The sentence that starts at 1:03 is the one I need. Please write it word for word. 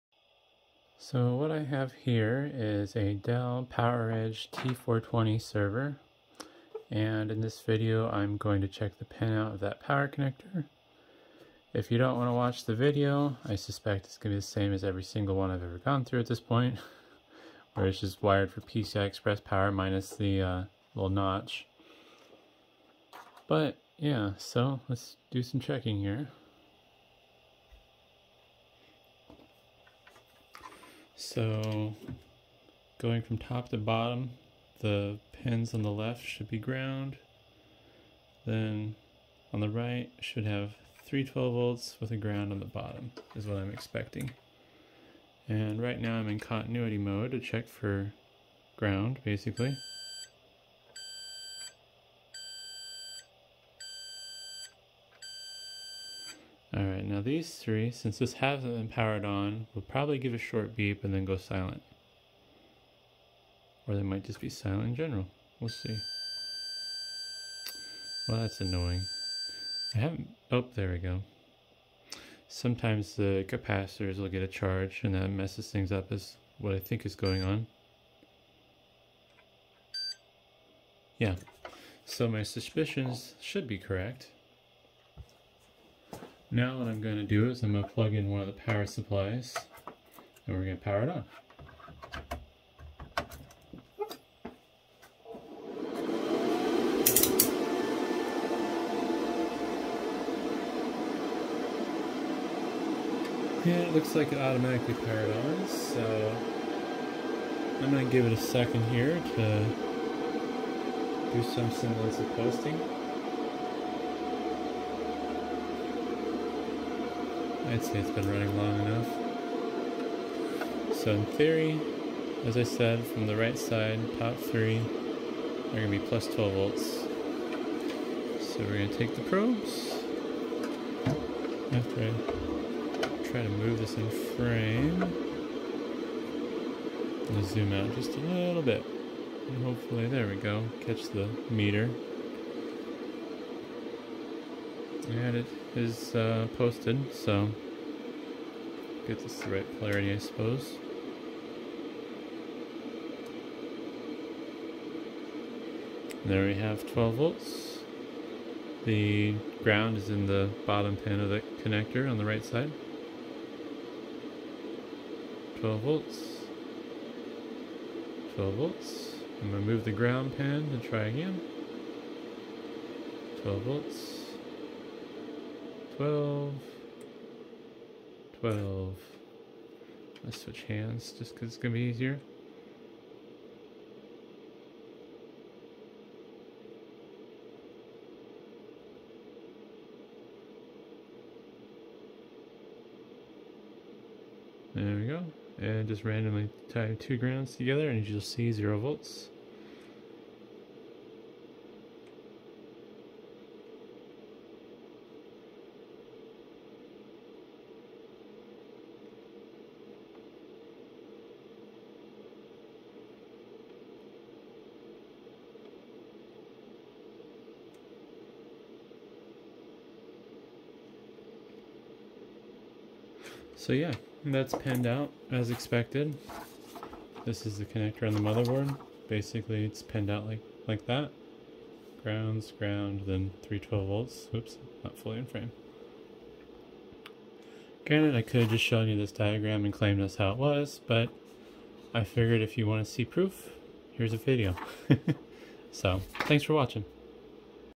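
Or they might just be silent in general.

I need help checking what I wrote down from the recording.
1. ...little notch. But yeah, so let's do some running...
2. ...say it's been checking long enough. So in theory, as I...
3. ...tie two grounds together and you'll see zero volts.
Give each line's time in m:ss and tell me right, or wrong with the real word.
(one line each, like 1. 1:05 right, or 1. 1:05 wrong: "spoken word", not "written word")
1. 0:20 wrong: "checking", not "running"
2. 1:57 wrong: "running", not "checking"
3. 3:16 right.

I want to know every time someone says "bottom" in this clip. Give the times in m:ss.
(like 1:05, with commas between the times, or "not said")
0:33, 0:42, 2:40.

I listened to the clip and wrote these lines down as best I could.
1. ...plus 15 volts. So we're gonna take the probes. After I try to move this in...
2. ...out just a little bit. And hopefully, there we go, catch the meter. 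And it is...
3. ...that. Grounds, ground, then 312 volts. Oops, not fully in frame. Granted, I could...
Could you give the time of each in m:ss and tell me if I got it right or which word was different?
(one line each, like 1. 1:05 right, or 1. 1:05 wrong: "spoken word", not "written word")
1. 2:05 wrong: "12", not "15"
2. 2:17 right
3. 3:50 right.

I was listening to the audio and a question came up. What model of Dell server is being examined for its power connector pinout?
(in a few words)
PowerEdge T420.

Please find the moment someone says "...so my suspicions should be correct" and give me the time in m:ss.
1:22.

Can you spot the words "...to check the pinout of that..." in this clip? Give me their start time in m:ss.
0:08.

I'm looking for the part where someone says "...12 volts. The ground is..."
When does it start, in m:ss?
2:36.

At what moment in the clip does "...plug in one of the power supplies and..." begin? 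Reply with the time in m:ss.
1:27.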